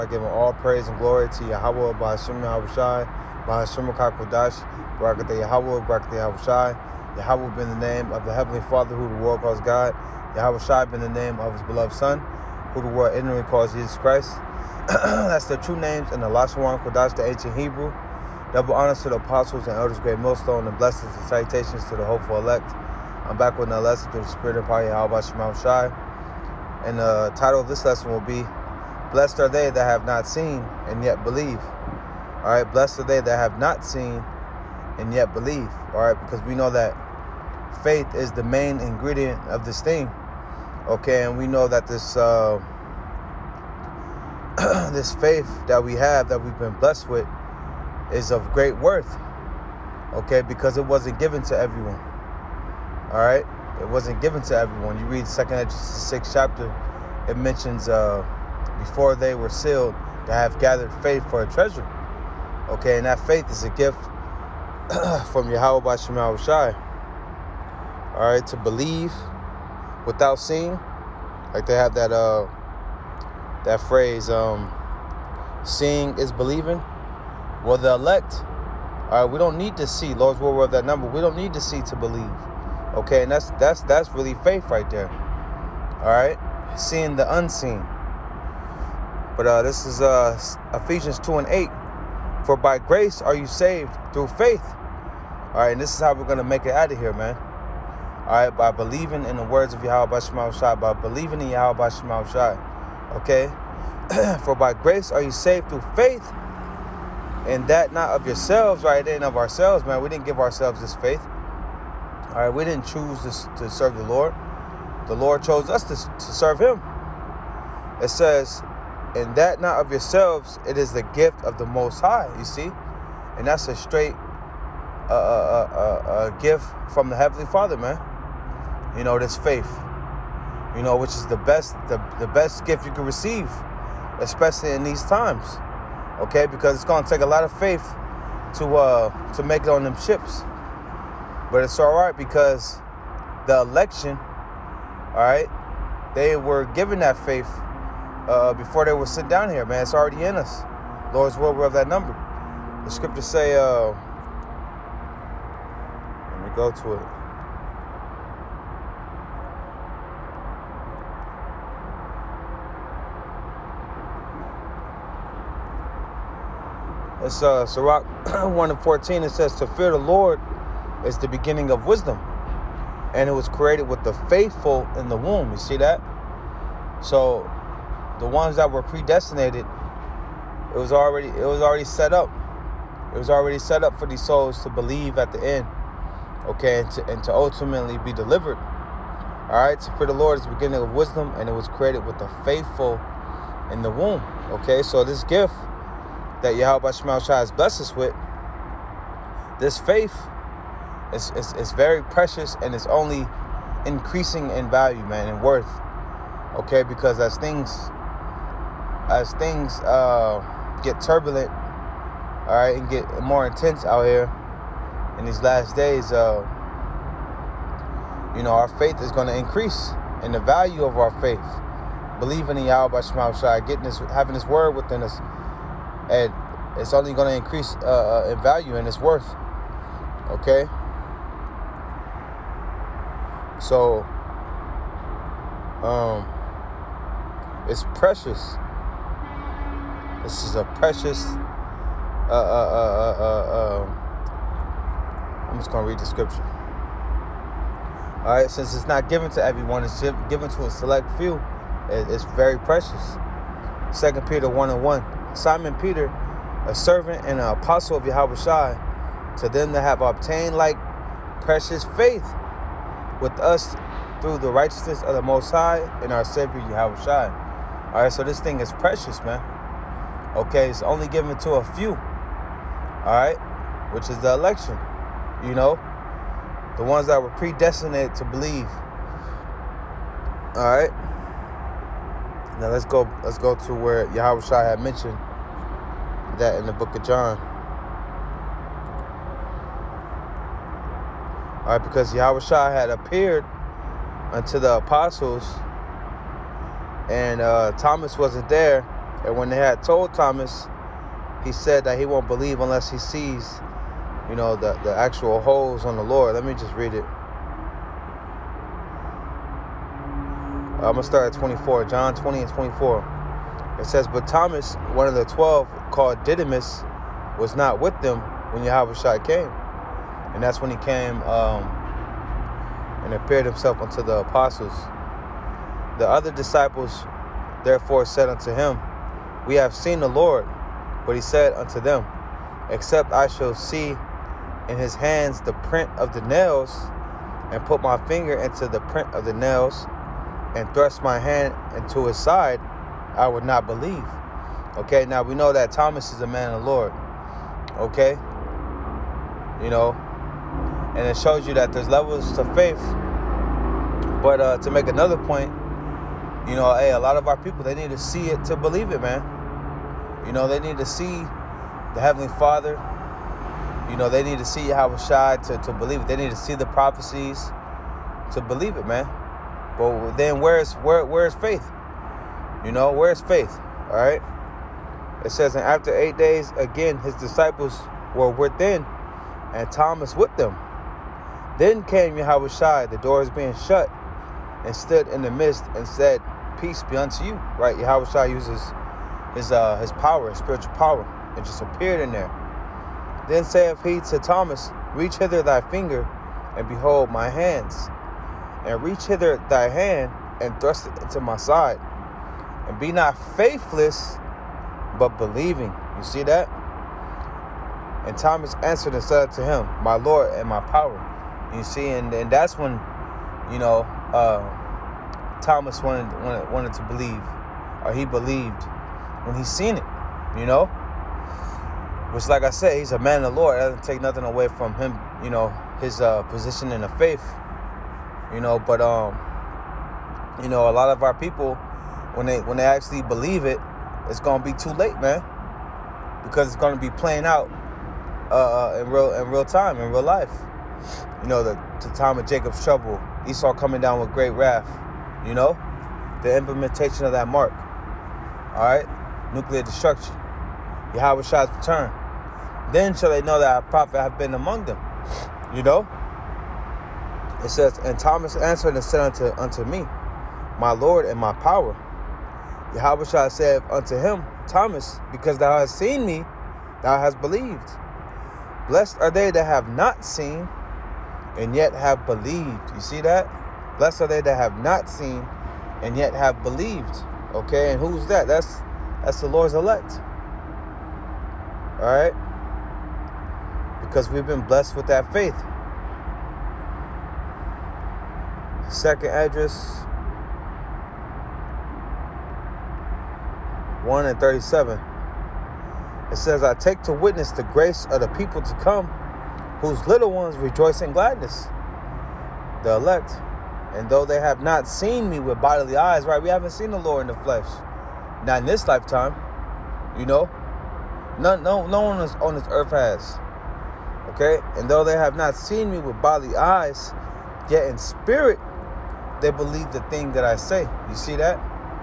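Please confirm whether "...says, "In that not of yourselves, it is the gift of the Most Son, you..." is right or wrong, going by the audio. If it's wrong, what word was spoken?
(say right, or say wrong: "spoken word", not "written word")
wrong: "High", not "Son".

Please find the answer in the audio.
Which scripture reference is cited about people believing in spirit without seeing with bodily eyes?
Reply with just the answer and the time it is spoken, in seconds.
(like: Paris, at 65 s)
2 Esdras 1:37, at 488 s.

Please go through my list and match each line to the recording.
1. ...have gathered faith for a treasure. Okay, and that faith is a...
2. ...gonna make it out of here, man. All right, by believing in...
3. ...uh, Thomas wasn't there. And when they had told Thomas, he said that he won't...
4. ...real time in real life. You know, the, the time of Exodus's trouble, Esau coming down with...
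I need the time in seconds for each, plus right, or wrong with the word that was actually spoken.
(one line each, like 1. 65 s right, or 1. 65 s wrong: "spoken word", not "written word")
1. 60 s right
2. 96 s right
3. 297 s right
4. 439 s wrong: "Jacob", not "Exodus".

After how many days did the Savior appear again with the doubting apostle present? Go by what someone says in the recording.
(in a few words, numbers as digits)
8.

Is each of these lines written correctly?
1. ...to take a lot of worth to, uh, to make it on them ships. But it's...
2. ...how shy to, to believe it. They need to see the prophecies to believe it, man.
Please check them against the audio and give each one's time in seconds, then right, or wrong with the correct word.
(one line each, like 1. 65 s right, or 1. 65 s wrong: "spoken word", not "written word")
1. 137 s wrong: "faith", not "worth"
2. 364 s right.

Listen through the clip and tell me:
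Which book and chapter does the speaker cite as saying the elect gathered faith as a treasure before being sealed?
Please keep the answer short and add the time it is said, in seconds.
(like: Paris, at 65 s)
Second Exodus 6, at 55 s.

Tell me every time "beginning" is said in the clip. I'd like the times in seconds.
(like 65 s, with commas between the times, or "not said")
171 s, 190 s.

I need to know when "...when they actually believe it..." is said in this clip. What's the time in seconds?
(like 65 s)
432 s.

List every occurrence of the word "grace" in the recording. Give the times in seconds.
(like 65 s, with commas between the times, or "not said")
92 s, 104 s, 497 s.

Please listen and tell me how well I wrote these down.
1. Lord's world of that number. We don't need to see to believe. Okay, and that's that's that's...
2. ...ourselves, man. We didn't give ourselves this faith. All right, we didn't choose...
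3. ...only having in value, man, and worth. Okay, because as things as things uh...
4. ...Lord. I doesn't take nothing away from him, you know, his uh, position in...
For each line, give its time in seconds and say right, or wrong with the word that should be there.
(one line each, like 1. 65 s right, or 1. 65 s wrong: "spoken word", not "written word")
1. 80 s right
2. 109 s right
3. 202 s wrong: "increasing", not "having"
4. 423 s right.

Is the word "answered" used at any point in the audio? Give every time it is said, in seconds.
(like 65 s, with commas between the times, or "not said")
408 s, 458 s.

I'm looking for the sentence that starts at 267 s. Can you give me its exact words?
All right, so this thing is precious, man.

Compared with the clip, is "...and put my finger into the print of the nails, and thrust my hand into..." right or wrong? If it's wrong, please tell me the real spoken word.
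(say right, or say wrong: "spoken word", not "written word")
right.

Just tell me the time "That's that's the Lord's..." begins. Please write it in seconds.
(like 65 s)
478 s.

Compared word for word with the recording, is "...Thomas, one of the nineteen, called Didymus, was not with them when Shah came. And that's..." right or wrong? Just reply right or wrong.
wrong.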